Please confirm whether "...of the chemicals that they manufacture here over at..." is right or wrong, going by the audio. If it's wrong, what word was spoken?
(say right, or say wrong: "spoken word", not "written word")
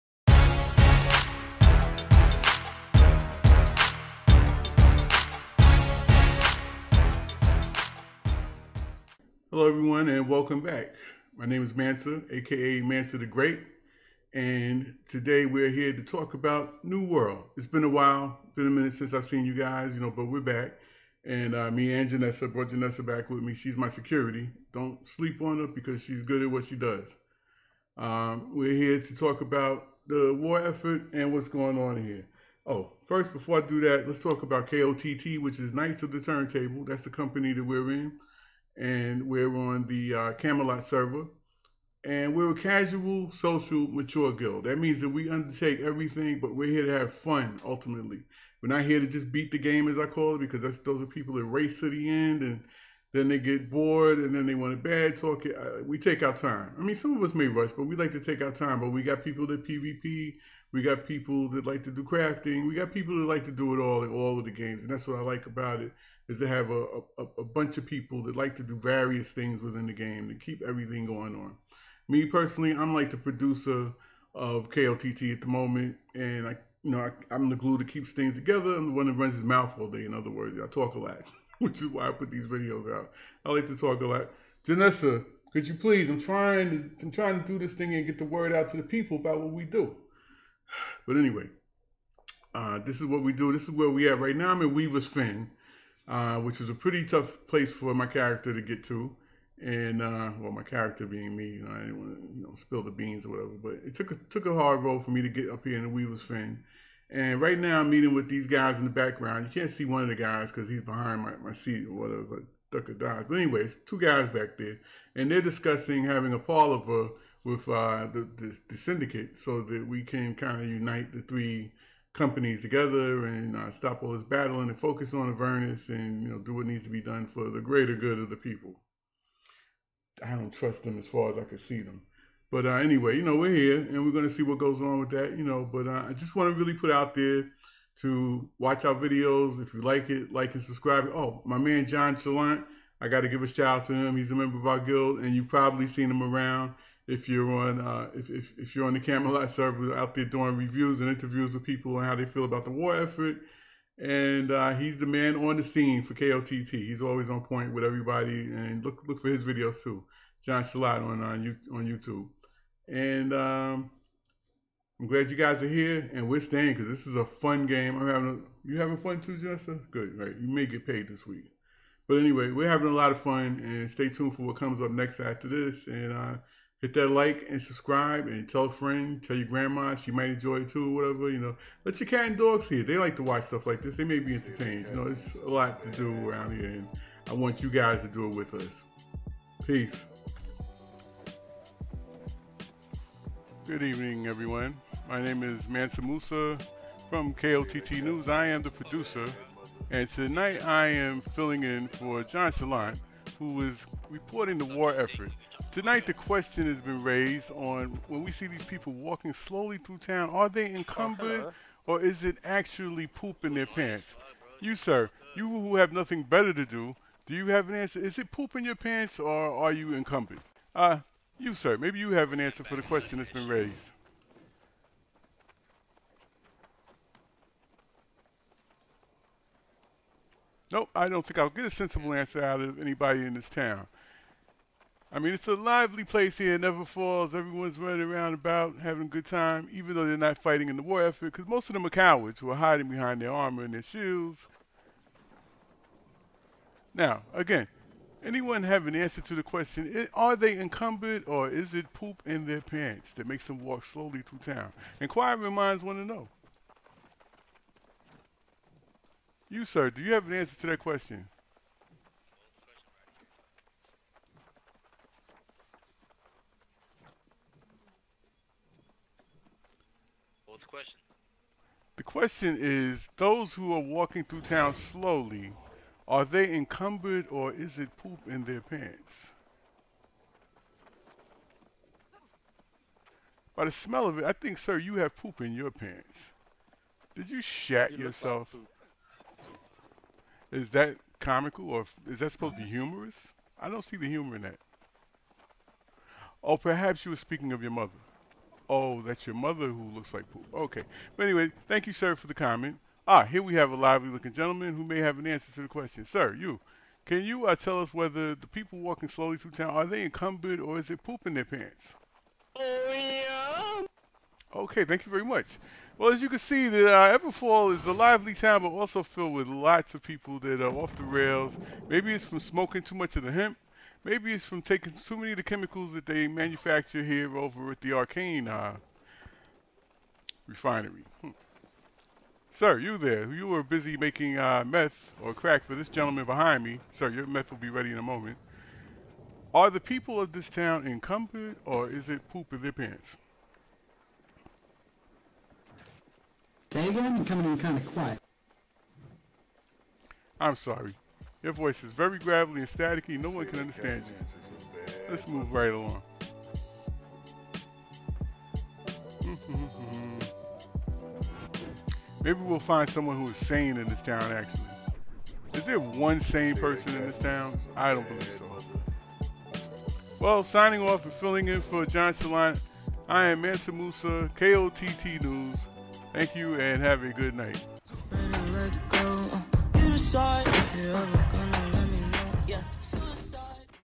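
right.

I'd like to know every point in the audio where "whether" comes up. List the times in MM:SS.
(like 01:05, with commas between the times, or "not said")
05:07.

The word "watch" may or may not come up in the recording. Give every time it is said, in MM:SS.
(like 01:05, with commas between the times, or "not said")
02:18, 03:03.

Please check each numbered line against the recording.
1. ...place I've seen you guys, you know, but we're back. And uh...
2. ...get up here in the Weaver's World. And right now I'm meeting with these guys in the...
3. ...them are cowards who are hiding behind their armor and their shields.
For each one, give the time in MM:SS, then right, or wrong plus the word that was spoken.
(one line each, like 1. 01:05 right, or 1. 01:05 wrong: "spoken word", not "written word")
1. 00:18 wrong: "since", not "place"
2. 01:45 wrong: "Fen", not "World"
3. 04:01 right.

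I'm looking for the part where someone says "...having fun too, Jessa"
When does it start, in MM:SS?
02:48.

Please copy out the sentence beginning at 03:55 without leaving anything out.
I mean, it's a lively place here, never falls.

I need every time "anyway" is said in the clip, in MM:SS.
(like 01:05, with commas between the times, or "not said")
01:31, 01:53, 02:12, 02:52, 05:01.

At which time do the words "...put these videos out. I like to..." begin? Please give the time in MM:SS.
01:22.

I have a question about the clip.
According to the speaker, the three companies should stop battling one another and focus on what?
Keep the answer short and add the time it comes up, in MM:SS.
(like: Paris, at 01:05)
Avernus, at 02:05.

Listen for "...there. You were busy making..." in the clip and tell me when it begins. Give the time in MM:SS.
05:32.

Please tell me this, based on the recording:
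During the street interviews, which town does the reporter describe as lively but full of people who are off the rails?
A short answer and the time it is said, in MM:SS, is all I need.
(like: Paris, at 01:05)
Everfall, at 05:17.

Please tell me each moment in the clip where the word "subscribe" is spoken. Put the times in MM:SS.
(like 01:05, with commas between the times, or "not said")
02:20, 02:57.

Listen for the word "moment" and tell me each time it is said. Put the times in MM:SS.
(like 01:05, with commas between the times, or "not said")
01:15, 05:38.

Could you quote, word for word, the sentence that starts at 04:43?
By the smell of it, I think, sir, you have poop in your pants.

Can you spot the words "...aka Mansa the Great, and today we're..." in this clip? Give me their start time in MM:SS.
00:12.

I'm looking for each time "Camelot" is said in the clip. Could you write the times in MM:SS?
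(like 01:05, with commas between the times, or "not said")
00:40, 02:28.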